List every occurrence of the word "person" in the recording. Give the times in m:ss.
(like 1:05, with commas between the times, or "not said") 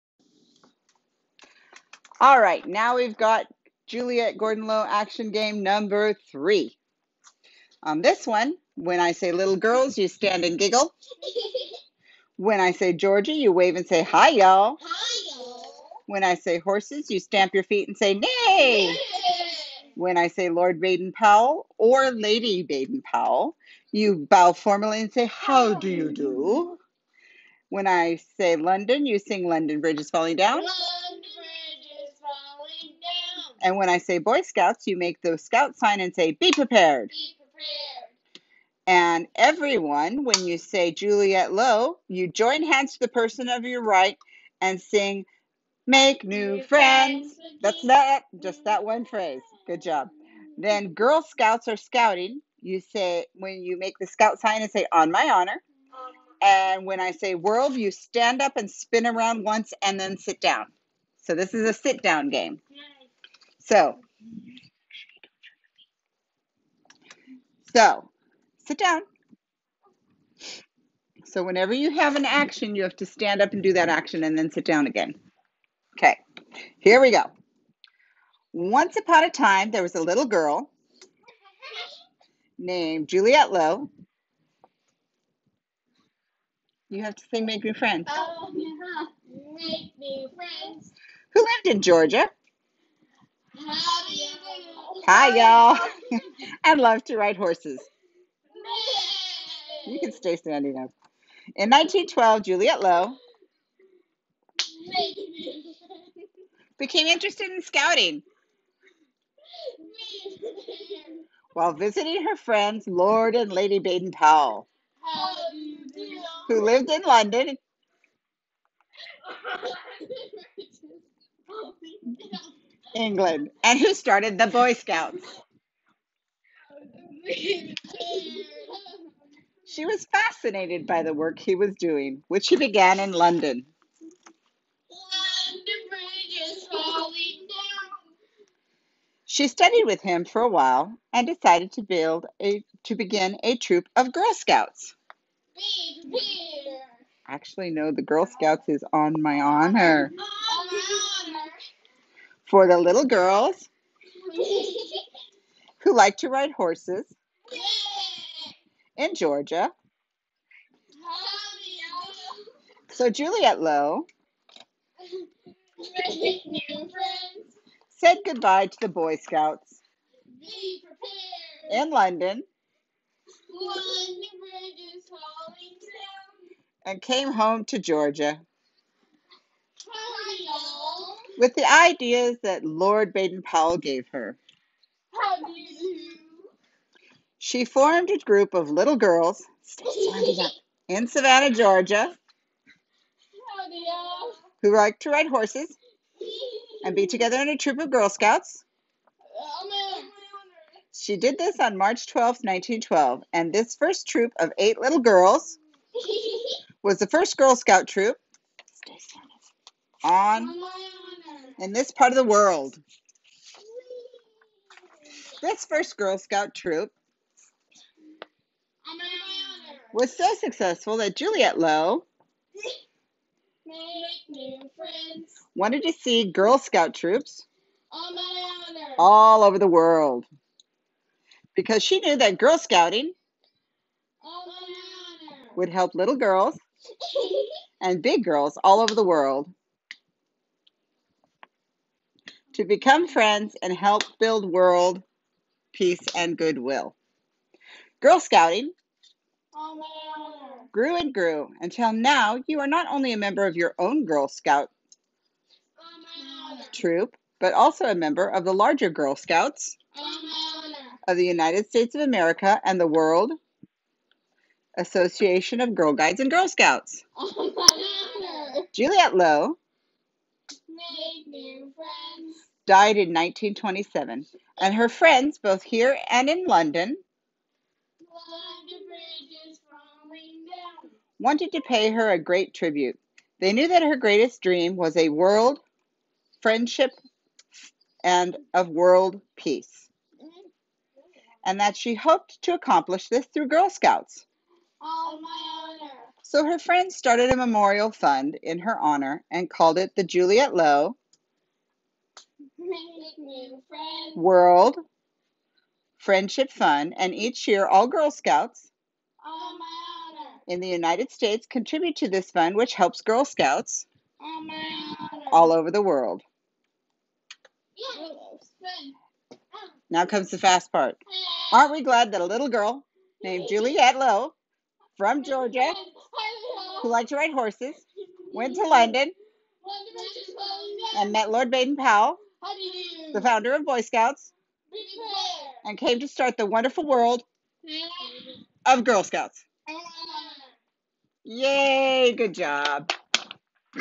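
0:43.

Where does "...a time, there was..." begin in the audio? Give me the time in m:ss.
1:19.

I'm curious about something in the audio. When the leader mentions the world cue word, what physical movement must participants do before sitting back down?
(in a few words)
Spin around once.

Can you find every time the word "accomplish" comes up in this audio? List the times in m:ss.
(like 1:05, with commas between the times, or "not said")
4:52.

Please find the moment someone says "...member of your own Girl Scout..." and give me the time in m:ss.
4:13.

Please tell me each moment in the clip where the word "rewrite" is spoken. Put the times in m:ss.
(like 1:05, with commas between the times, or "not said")
not said.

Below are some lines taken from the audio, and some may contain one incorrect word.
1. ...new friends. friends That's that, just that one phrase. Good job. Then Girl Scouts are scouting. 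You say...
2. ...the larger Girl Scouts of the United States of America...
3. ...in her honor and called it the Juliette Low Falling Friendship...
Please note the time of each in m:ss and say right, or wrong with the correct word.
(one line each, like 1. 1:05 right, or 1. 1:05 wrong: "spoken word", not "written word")
1. 0:46 right
2. 4:18 right
3. 4:58 wrong: "World", not "Falling".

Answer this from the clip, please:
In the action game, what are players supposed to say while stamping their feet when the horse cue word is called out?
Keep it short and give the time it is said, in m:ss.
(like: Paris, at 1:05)
Nay, at 0:18.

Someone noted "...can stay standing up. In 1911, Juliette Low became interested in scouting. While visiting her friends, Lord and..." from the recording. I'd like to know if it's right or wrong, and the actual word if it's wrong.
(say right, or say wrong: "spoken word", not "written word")
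wrong: "1912", not "1911".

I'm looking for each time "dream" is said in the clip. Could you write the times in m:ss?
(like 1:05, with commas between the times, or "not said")
4:44.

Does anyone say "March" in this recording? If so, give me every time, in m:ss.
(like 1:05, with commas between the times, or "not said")
3:21.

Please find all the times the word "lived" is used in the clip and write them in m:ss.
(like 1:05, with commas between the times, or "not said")
1:31, 1:56.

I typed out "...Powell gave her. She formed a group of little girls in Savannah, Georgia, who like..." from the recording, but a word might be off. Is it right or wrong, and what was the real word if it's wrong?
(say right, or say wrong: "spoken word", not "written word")
right.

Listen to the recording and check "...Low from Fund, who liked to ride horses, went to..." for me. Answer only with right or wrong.
wrong.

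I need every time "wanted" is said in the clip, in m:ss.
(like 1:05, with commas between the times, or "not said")
3:45, 4:41.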